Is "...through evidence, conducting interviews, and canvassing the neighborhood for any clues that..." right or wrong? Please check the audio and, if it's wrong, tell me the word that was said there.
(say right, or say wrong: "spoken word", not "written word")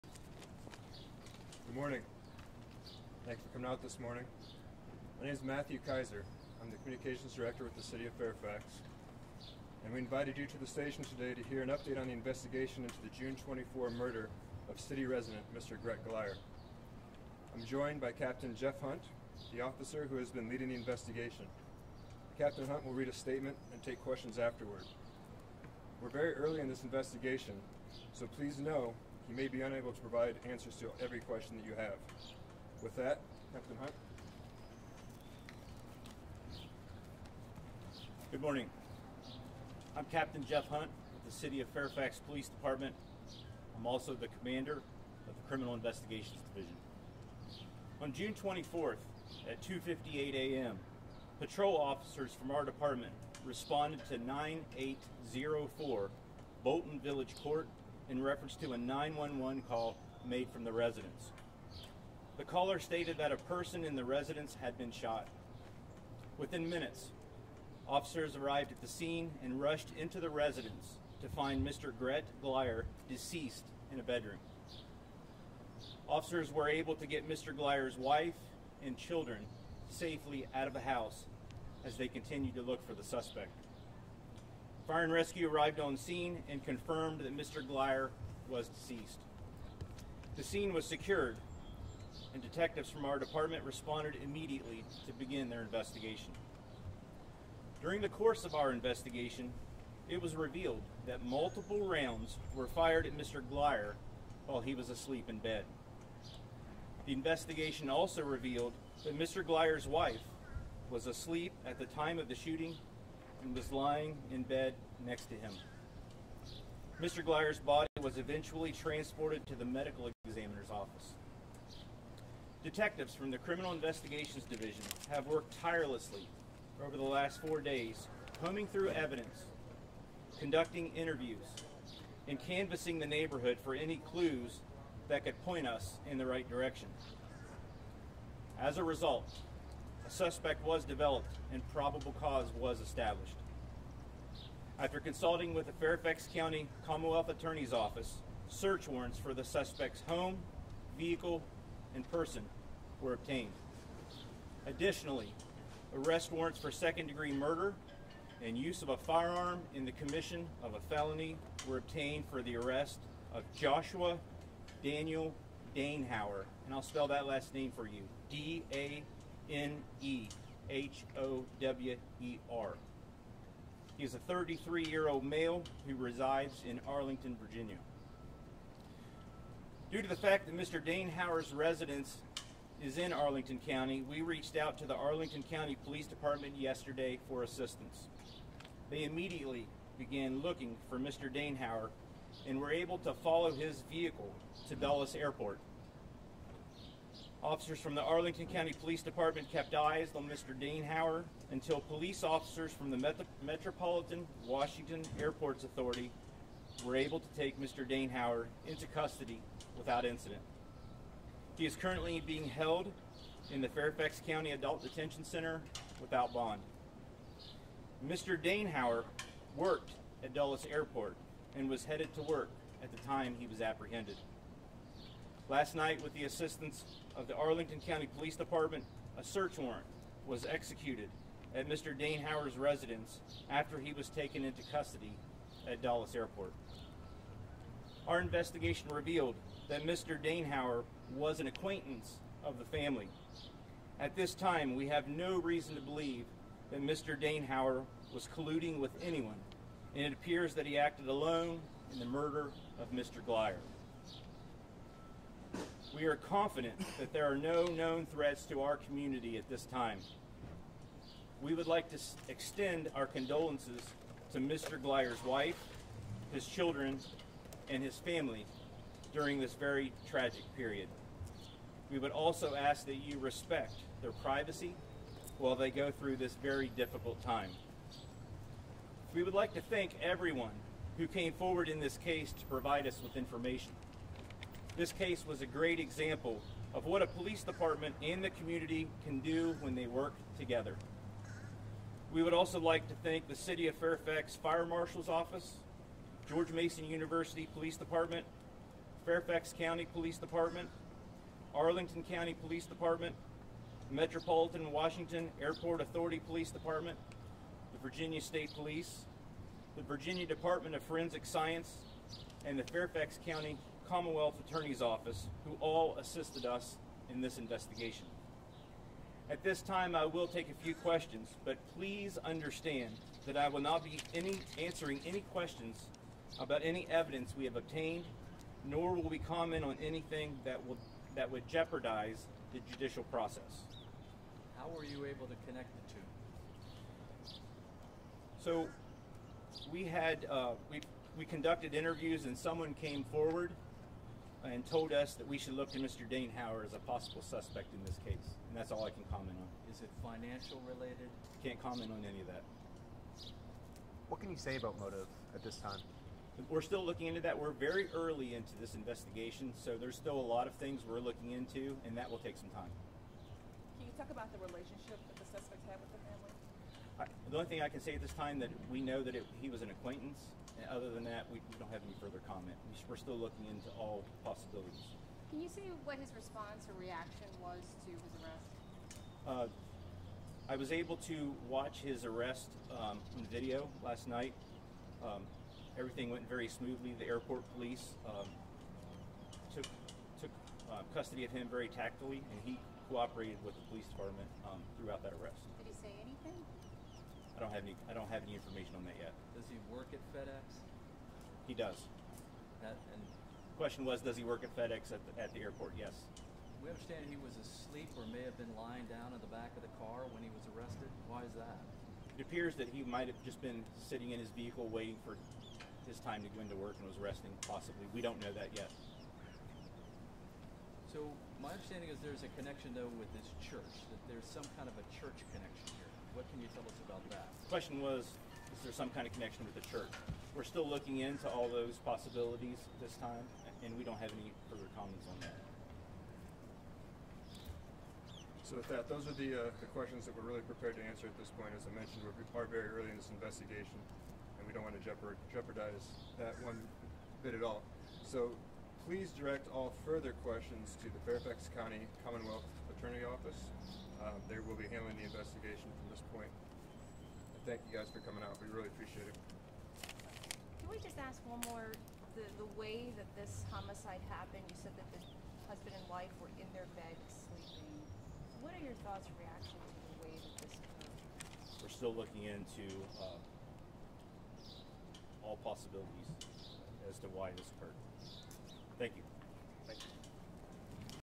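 right.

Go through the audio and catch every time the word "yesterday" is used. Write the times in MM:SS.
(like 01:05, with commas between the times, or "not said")
03:06.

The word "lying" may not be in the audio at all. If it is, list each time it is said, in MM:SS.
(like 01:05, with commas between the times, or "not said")
01:53, 06:48.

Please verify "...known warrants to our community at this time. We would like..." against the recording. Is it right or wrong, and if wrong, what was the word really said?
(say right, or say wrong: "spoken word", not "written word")
wrong: "threats", not "warrants".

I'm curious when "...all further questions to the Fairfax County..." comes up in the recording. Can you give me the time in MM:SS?
07:29.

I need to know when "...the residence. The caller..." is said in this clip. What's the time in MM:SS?
01:00.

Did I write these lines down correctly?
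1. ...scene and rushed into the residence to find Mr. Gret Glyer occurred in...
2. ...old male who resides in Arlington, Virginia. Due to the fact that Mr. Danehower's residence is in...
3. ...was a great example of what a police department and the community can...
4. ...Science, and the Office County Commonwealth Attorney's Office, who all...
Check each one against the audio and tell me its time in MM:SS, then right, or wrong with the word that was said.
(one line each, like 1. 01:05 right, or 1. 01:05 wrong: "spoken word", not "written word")
1. 01:08 wrong: "deceased", not "occurred"
2. 02:55 right
3. 04:45 right
4. 05:11 wrong: "Fairfax", not "Office".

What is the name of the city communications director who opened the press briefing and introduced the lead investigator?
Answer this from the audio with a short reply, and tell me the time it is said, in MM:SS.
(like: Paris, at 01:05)
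Matthew Kaiser, at 00:05.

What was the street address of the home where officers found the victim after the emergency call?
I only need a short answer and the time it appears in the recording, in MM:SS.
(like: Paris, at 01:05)
9804 Bolton Village Court, at 00:54.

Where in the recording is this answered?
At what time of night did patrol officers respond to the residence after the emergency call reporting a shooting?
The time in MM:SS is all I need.
00:49.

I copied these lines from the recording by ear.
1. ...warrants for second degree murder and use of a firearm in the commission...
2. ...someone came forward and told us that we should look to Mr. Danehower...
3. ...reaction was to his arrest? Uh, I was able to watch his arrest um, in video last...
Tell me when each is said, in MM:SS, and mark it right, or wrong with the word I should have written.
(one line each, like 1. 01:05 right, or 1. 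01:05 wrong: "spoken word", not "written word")
1. 02:36 right
2. 05:42 right
3. 06:16 right.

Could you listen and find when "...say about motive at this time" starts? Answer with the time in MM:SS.
05:54.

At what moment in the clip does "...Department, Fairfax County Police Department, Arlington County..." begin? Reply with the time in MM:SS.
04:57.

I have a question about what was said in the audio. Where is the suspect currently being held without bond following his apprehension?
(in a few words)
Fairfax County Adult Detention Center.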